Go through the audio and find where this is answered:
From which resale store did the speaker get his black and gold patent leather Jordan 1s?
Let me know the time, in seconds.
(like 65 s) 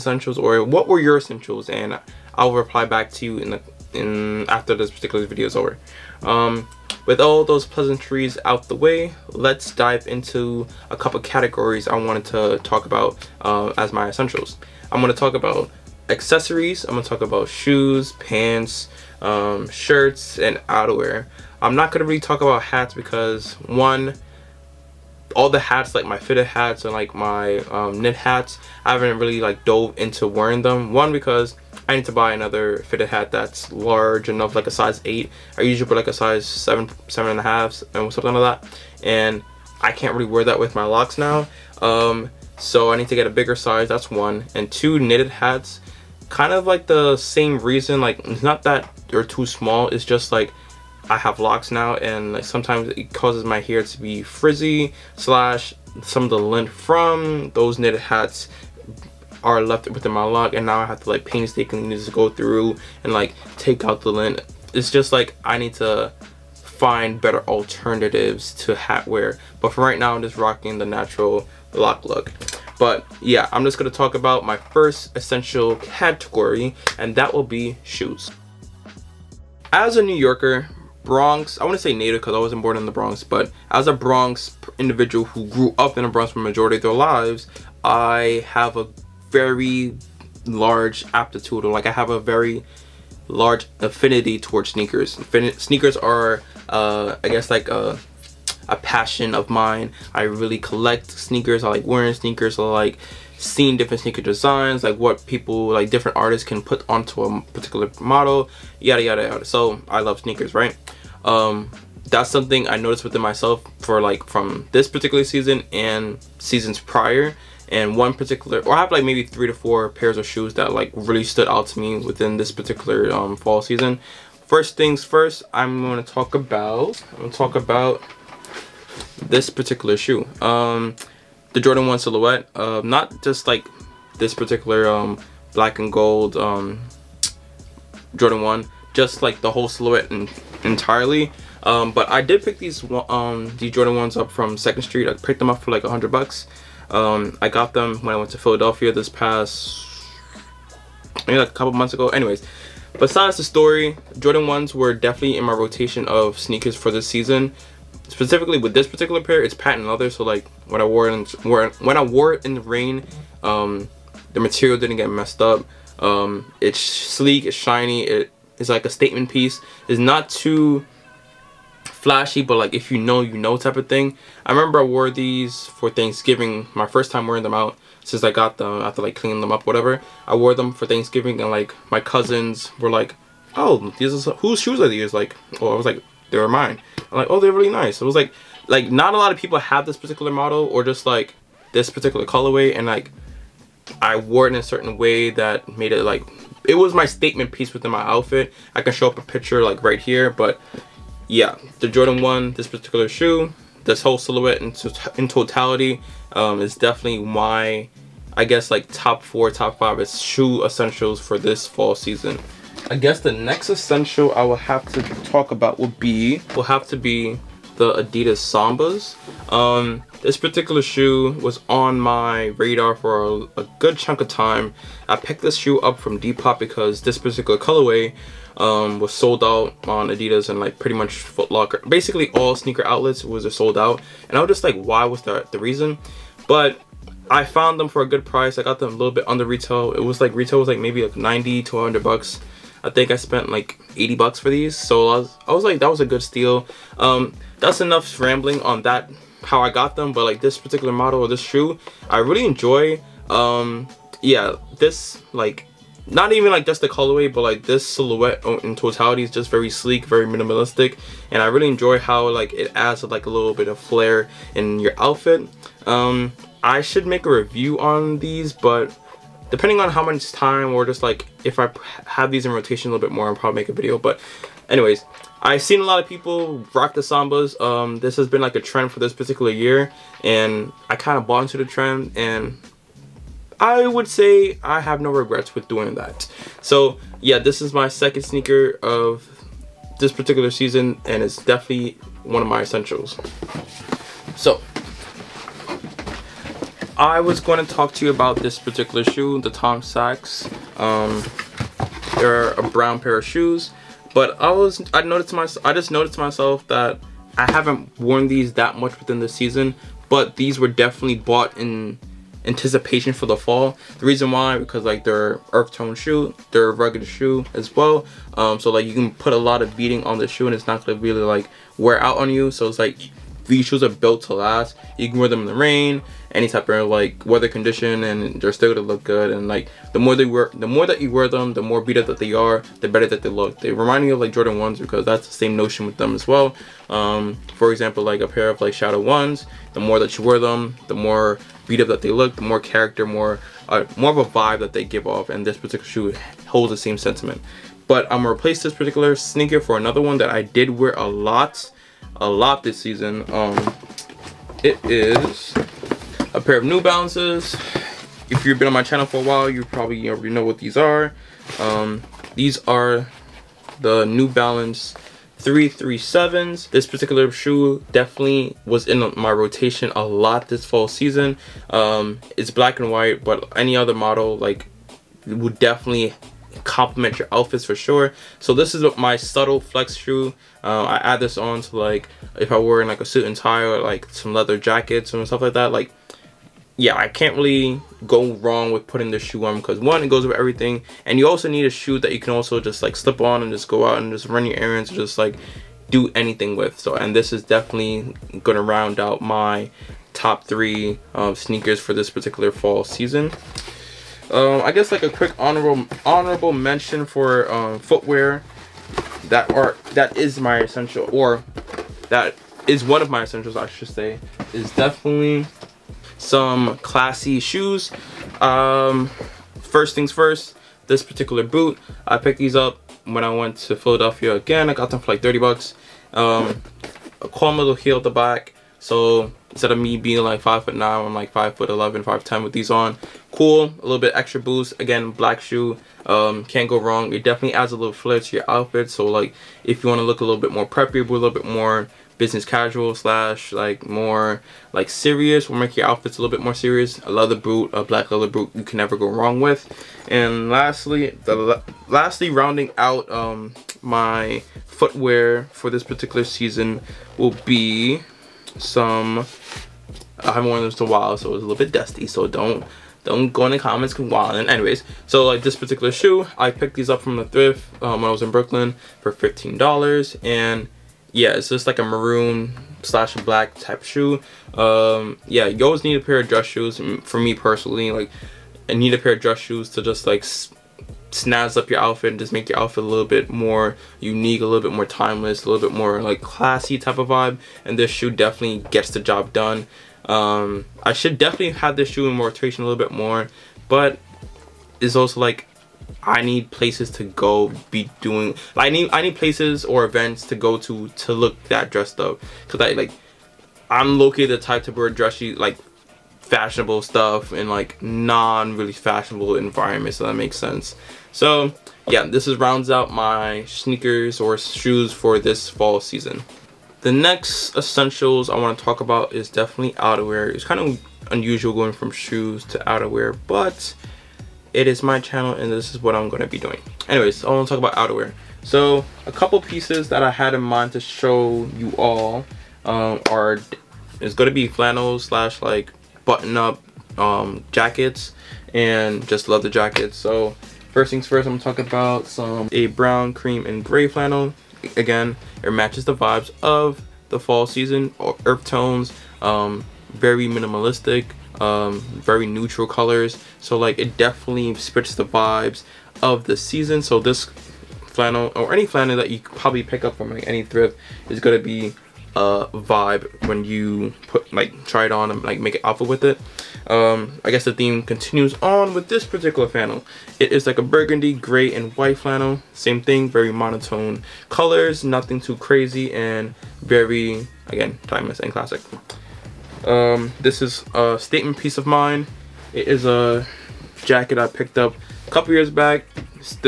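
144 s.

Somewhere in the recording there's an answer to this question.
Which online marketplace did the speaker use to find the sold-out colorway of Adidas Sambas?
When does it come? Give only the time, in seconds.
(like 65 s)
226 s.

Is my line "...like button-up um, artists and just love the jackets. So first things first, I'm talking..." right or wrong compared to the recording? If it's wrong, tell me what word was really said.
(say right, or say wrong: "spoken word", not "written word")
wrong: "jackets", not "artists".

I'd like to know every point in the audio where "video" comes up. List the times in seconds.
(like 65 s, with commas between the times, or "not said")
5 s, 273 s.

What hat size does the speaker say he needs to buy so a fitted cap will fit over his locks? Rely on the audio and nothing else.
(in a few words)
size 8.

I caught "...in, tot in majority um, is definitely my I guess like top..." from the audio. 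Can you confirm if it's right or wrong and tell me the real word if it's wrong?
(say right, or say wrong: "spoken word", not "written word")
wrong: "totality", not "majority".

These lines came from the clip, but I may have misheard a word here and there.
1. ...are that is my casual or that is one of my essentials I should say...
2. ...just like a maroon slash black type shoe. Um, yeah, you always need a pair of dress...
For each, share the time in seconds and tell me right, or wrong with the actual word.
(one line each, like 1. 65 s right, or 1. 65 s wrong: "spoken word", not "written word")
1. 409 s wrong: "essential", not "casual"
2. 471 s right.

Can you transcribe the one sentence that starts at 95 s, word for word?
sneakers are, uh, I guess, like a, a passion of mine.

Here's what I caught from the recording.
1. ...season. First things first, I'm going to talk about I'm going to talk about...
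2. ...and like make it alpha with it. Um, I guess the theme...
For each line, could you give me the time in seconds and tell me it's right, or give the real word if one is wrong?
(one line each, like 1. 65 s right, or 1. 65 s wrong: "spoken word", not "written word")
1. 123 s right
2. 565 s right.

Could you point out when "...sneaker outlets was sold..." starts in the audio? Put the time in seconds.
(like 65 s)
232 s.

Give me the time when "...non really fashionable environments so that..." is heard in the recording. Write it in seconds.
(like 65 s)
507 s.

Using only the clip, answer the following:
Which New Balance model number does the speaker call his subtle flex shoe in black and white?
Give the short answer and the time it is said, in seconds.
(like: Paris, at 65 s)
337, at 365 s.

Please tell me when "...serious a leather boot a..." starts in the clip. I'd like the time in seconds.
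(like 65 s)
446 s.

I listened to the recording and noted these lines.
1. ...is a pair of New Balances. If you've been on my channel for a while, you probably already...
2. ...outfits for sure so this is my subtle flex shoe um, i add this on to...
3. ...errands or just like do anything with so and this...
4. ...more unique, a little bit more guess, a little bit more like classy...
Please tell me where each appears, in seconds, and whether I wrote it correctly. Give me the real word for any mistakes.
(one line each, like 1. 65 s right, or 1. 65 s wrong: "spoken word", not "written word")
1. 354 s right
2. 377 s right
3. 394 s right
4. 483 s wrong: "timeless", not "guess".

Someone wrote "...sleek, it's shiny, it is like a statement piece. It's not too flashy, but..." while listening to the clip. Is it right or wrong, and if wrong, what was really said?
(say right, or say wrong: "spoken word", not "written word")
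right.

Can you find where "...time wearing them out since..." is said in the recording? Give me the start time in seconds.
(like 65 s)
177 s.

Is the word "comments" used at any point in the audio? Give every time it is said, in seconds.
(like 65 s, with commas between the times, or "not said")
463 s.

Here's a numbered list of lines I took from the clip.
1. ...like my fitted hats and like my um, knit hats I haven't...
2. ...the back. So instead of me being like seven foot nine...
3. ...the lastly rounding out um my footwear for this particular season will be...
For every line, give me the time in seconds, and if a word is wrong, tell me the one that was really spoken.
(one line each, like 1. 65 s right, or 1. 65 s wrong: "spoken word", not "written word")
1. 25 s right
2. 428 s wrong: "five", not "seven"
3. 451 s right.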